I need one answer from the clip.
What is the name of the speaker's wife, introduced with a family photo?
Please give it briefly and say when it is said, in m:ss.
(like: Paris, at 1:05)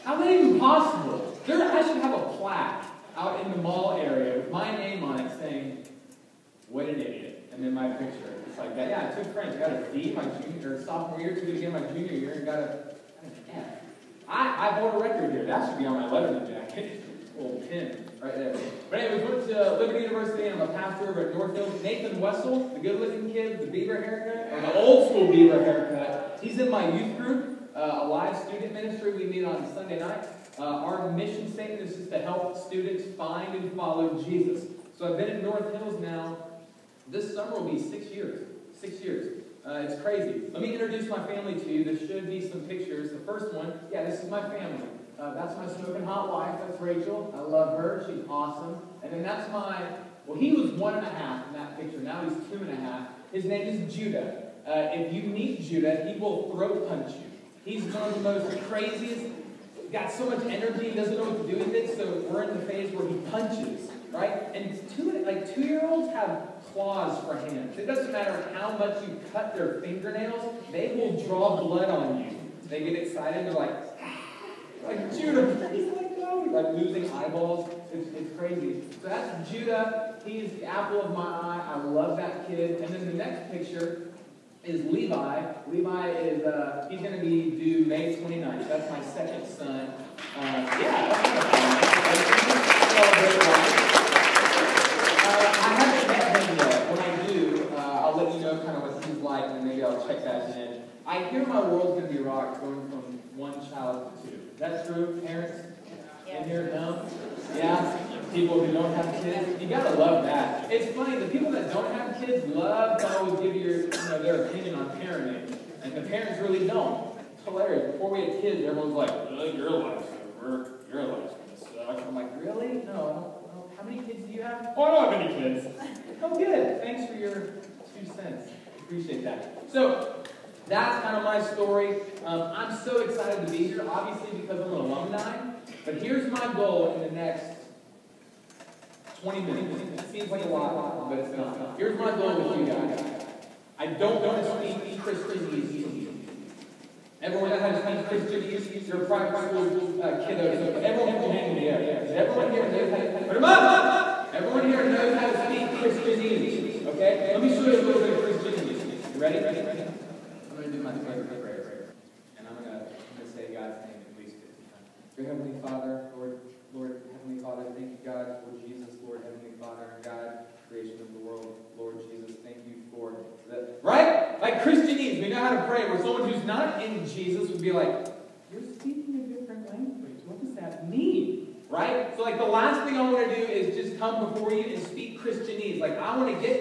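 Rachel, at 0:46.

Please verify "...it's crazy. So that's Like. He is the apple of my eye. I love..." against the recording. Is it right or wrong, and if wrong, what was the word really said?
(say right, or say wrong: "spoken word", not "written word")
wrong: "Judah", not "Like".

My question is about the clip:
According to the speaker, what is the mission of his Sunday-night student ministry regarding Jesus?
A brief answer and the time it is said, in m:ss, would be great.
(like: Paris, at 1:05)
find and follow Jesus, at 0:33.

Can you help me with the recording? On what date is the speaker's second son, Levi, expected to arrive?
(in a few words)
May 29.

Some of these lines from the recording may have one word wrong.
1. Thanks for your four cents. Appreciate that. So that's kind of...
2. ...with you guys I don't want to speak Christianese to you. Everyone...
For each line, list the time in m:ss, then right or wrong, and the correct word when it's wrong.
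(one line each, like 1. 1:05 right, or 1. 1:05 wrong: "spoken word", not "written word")
1. 2:06 wrong: "two", not "four"
2. 2:22 right.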